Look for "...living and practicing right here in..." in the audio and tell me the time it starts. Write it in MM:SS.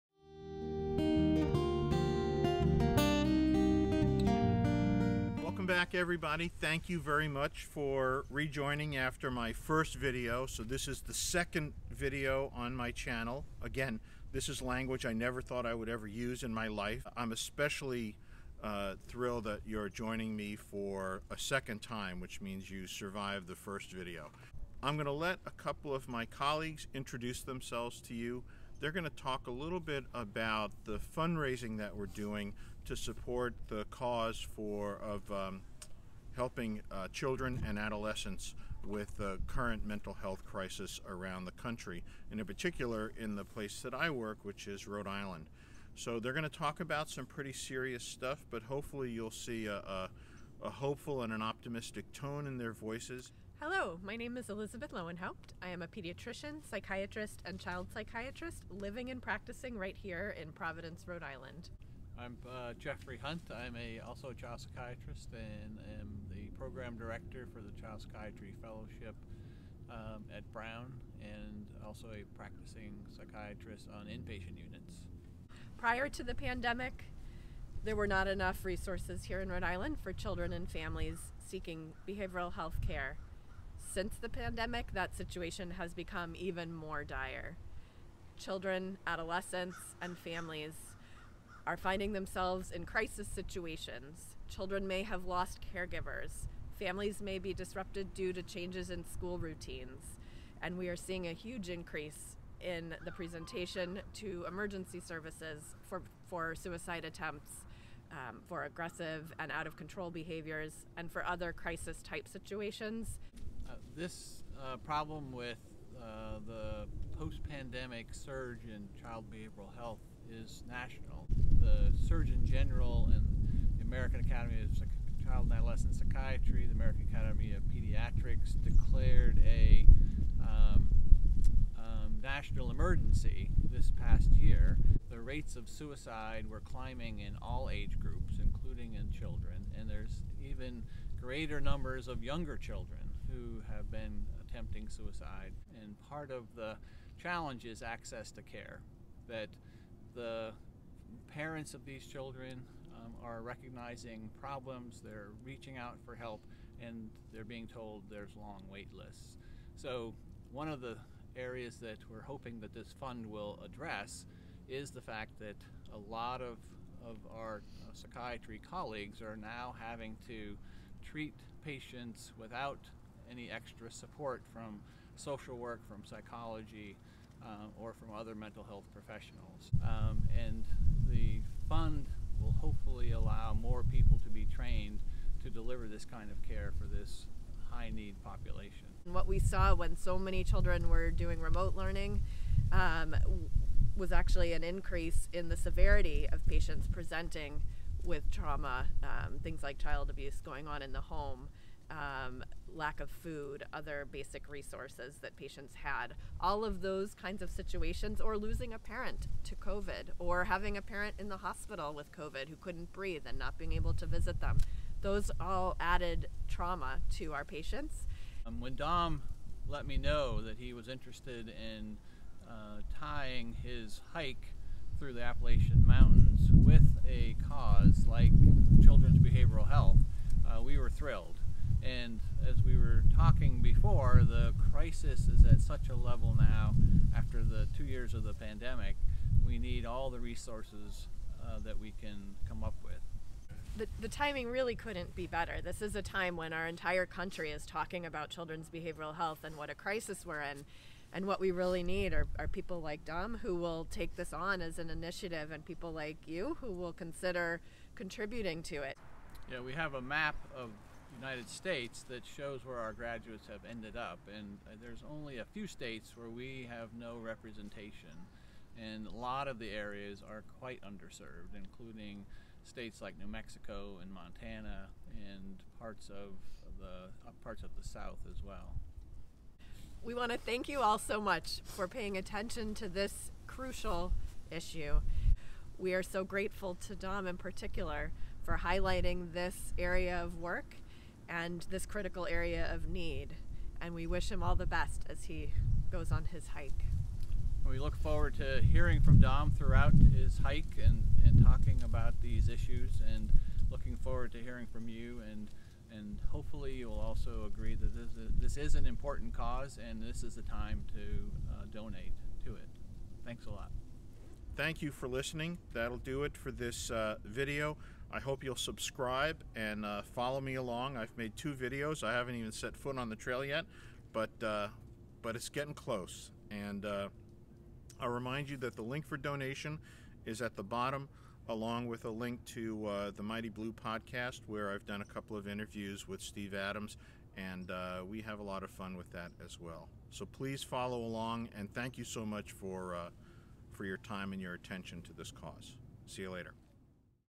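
00:58.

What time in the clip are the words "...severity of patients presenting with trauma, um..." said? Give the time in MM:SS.
03:15.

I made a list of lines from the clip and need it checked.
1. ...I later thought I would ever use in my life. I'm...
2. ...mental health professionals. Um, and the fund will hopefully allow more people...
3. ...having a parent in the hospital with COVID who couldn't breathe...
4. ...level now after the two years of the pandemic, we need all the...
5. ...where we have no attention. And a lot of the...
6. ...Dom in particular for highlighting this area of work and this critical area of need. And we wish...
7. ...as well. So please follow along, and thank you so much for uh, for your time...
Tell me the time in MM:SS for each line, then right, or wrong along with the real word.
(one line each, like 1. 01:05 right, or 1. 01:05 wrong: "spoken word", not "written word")
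1. 00:15 wrong: "never", not "later"
2. 02:58 right
3. 03:30 right
4. 03:55 right
5. 04:26 wrong: "representation", not "attention"
6. 04:46 right
7. 05:39 right.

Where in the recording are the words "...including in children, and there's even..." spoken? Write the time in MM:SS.
02:18.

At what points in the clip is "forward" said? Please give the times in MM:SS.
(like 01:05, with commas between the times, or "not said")
04:57, 05:03.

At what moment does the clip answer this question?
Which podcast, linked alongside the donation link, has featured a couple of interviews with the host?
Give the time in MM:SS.
05:33.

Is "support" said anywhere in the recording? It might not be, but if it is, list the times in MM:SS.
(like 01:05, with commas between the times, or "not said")
00:32, 02:53.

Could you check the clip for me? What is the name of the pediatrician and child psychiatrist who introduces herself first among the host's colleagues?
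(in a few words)
Elizabeth Lowenhaupt.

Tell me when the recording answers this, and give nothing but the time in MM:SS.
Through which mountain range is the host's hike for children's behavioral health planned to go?
03:45.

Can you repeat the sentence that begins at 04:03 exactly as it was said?
The, the timing really couldn't be better.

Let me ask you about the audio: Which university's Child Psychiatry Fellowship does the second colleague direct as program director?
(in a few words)
Brown.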